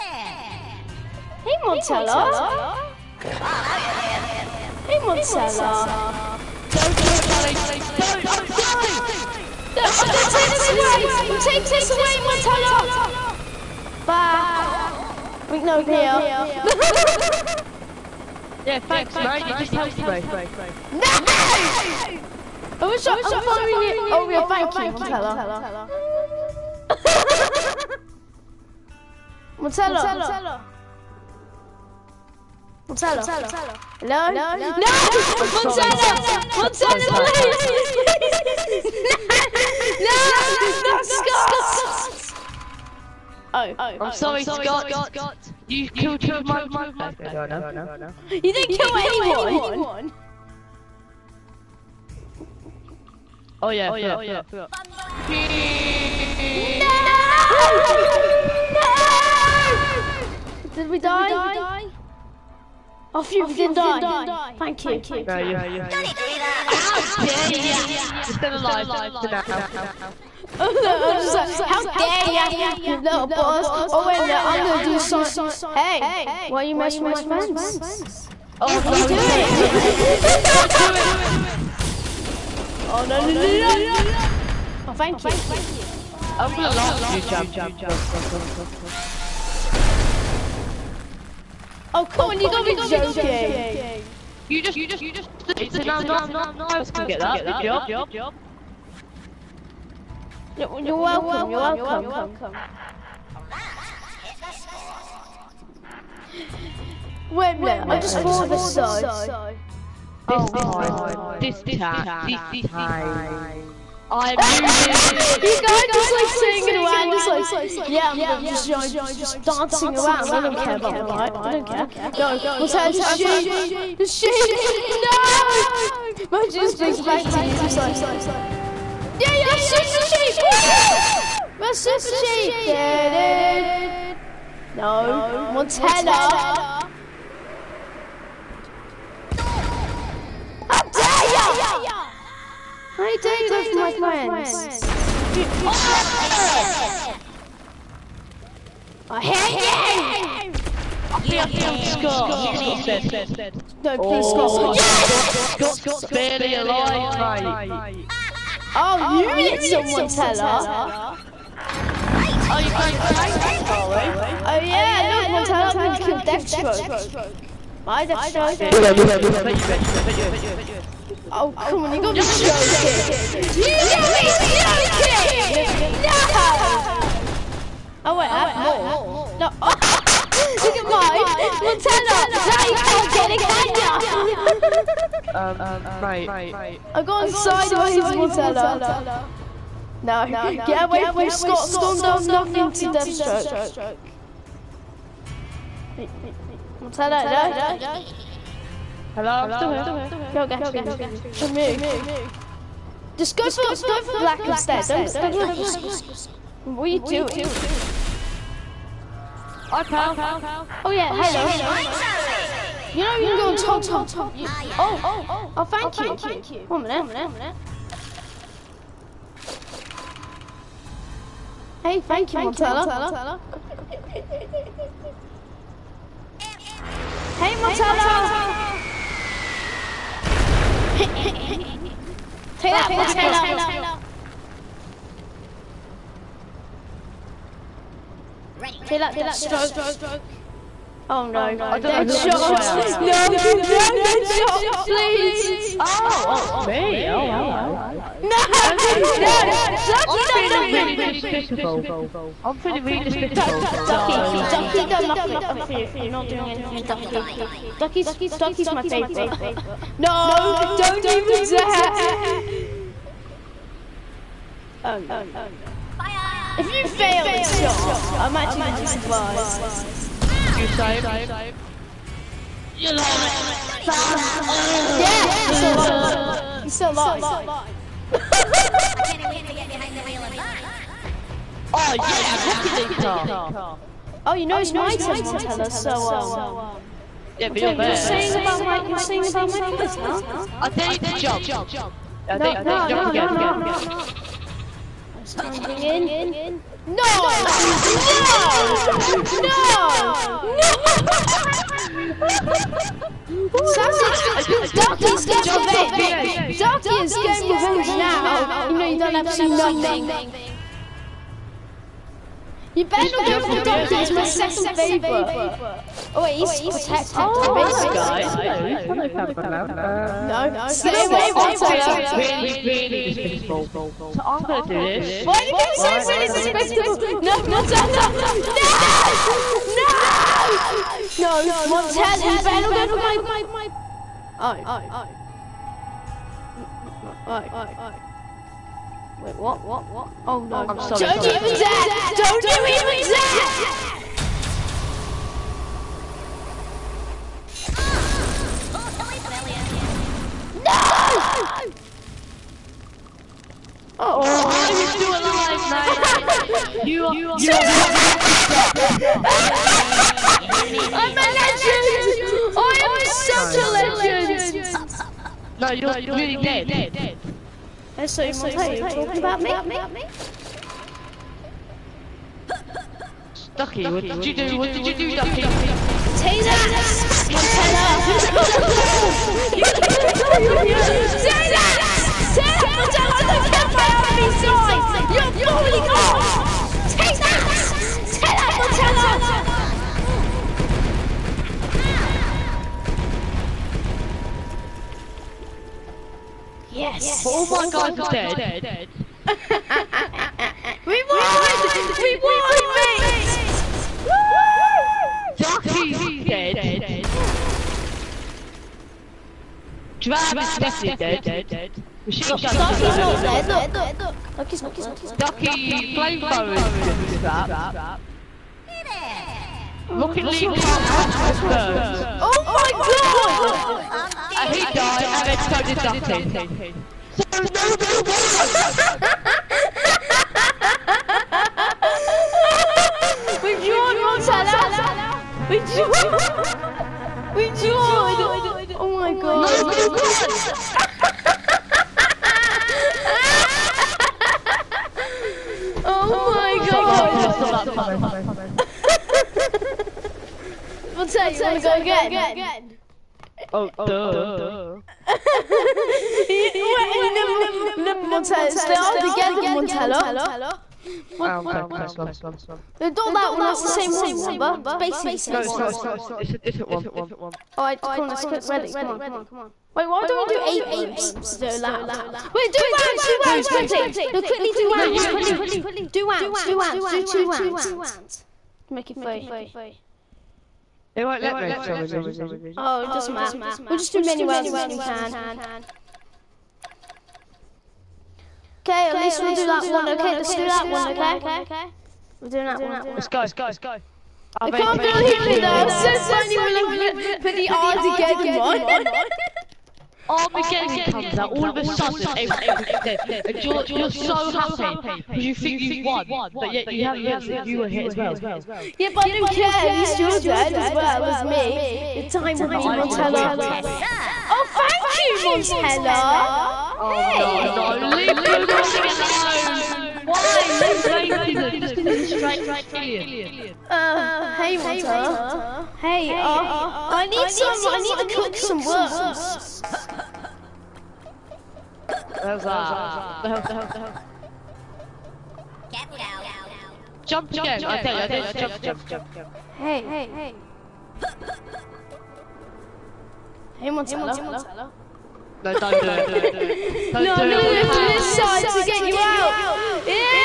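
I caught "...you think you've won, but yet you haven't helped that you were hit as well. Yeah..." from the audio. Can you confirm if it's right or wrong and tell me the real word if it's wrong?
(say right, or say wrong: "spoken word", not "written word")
wrong: "realised", not "helped".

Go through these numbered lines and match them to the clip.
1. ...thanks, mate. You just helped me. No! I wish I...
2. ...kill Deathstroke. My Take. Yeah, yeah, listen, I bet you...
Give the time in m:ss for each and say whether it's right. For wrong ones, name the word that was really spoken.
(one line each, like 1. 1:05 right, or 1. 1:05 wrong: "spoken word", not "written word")
1. 0:18 right
2. 2:45 wrong: "Deathstroke", not "Take".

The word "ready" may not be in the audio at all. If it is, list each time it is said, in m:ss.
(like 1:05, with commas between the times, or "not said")
3:58, 7:48.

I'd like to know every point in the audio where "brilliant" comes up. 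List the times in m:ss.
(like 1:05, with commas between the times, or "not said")
5:50.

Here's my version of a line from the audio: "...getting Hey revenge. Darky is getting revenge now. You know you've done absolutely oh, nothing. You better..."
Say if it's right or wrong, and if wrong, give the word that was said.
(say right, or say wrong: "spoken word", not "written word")
wrong: "Jump", not "Hey".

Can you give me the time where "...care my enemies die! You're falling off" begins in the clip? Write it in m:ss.
6:23.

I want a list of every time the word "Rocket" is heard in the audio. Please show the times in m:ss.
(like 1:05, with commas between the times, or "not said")
7:00.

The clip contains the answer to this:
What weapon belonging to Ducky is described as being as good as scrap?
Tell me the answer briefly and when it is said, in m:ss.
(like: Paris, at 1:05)
flamethrower, at 6:55.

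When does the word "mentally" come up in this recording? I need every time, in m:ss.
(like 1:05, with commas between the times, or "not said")
not said.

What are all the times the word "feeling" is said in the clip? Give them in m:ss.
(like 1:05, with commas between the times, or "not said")
4:12, 5:22.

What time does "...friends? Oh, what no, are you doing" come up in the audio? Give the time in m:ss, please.
1:17.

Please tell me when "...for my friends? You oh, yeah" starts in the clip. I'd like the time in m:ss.
2:23.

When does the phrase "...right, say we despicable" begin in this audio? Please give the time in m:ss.
5:25.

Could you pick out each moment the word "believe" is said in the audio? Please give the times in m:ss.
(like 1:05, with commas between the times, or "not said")
8:14.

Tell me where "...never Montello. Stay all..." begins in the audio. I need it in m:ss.
7:37.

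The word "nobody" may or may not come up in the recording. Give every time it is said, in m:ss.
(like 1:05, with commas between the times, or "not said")
7:07, 7:19.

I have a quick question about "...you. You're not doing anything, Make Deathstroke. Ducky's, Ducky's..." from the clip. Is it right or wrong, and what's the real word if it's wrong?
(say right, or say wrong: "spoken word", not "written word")
wrong: "Ducky", not "Deathstroke".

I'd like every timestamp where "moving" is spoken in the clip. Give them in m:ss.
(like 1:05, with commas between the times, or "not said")
1:54.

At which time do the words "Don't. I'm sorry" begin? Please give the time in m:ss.
0:07.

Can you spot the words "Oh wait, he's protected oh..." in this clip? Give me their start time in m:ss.
5:16.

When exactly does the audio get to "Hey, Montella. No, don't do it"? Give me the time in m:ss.
9:03.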